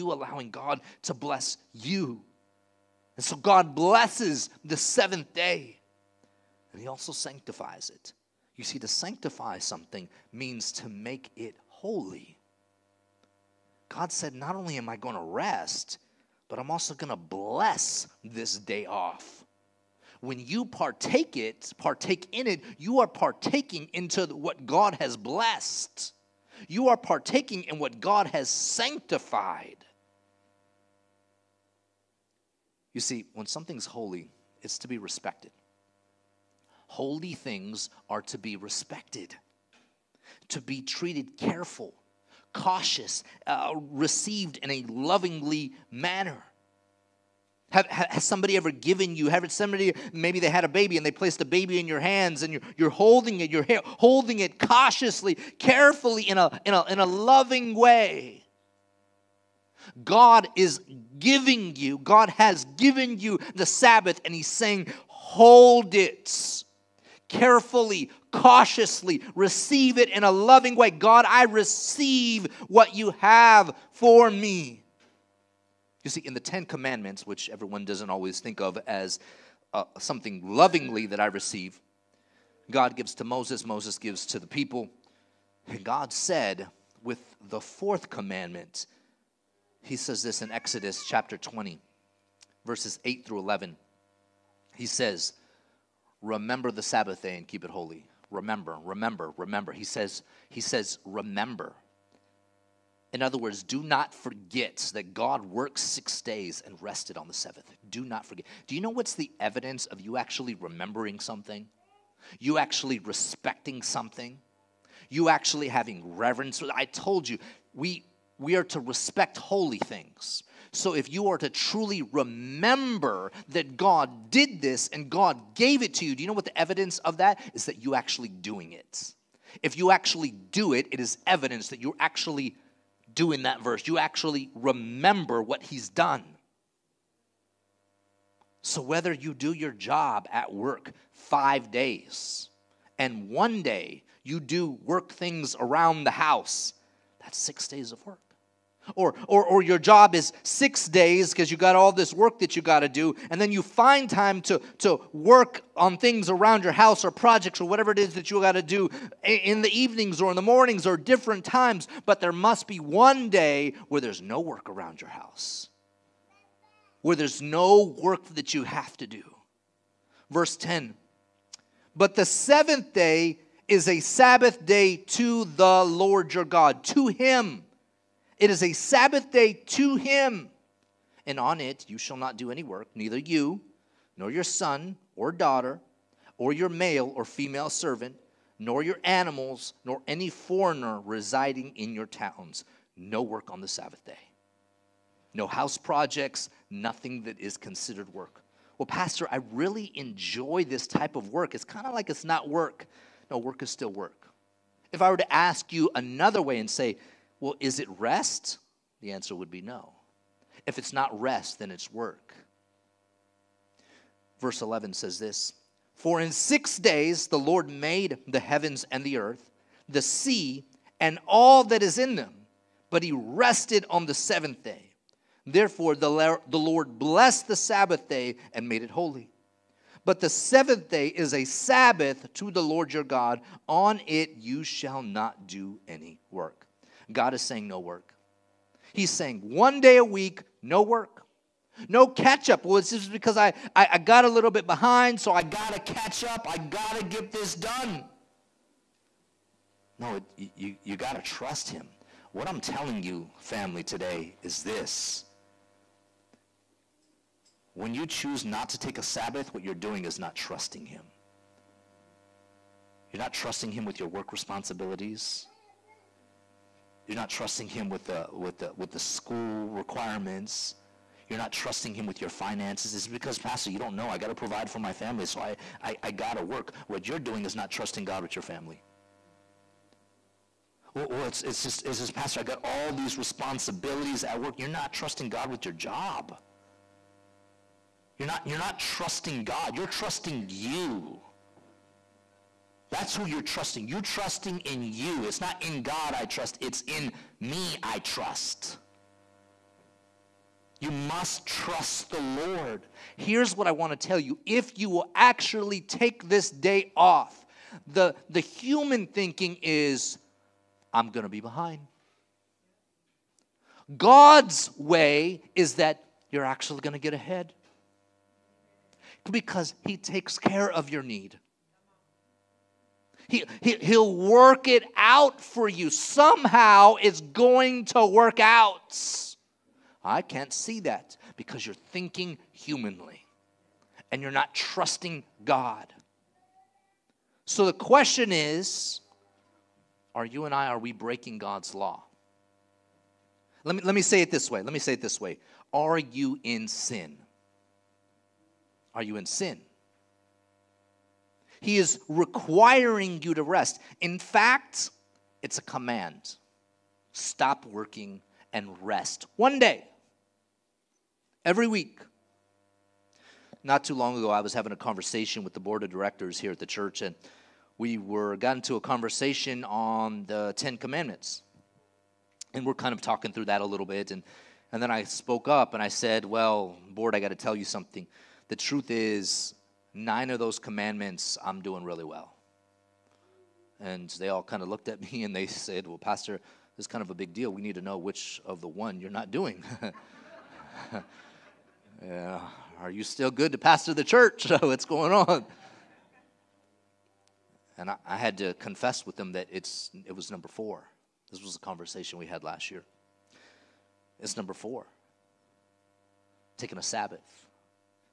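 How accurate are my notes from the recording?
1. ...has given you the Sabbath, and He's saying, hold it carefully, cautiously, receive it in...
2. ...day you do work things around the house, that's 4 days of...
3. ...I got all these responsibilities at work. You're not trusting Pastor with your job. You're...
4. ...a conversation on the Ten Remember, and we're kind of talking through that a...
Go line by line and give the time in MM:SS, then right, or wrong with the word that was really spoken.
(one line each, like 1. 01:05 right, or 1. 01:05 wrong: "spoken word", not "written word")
1. 01:02 right
2. 02:23 wrong: "6", not "4"
3. 04:42 wrong: "God", not "Pastor"
4. 06:08 wrong: "Commandments", not "Remember".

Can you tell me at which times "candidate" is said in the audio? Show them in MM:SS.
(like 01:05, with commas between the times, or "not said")
not said.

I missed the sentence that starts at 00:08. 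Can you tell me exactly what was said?
You see, to sanctify something means to make it holy.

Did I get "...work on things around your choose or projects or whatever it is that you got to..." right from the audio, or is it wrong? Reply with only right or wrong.
wrong.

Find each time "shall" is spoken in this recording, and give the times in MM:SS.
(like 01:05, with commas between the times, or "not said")
03:01, 03:54.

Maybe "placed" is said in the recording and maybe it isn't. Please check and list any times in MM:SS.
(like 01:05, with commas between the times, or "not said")
00:51.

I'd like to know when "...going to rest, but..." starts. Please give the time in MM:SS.
00:14.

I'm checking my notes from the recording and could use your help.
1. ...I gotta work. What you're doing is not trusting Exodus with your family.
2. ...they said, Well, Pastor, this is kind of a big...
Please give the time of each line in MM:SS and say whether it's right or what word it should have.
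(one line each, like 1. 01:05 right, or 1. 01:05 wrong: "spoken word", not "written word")
1. 04:36 wrong: "God", not "Exodus"
2. 06:25 right.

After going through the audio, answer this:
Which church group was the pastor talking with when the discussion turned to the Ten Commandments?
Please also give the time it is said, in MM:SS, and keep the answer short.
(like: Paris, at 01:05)
the board of directors, at 06:05.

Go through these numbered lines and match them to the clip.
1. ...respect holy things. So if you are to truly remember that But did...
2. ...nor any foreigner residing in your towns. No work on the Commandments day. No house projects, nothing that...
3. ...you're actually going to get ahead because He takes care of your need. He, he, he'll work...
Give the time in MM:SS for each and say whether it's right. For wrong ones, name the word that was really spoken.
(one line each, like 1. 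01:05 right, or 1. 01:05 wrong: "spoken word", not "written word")
1. 01:58 wrong: "God", not "But"
2. 03:09 wrong: "Sabbath", not "Commandments"
3. 05:16 right.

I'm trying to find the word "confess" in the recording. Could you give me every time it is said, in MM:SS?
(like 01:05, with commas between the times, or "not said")
06:38.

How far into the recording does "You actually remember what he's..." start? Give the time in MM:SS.
02:13.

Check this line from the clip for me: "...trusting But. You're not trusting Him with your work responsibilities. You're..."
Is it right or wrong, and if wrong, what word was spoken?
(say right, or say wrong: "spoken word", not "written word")
wrong: "Him", not "But".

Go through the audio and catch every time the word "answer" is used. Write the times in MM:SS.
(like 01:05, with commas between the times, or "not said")
03:29.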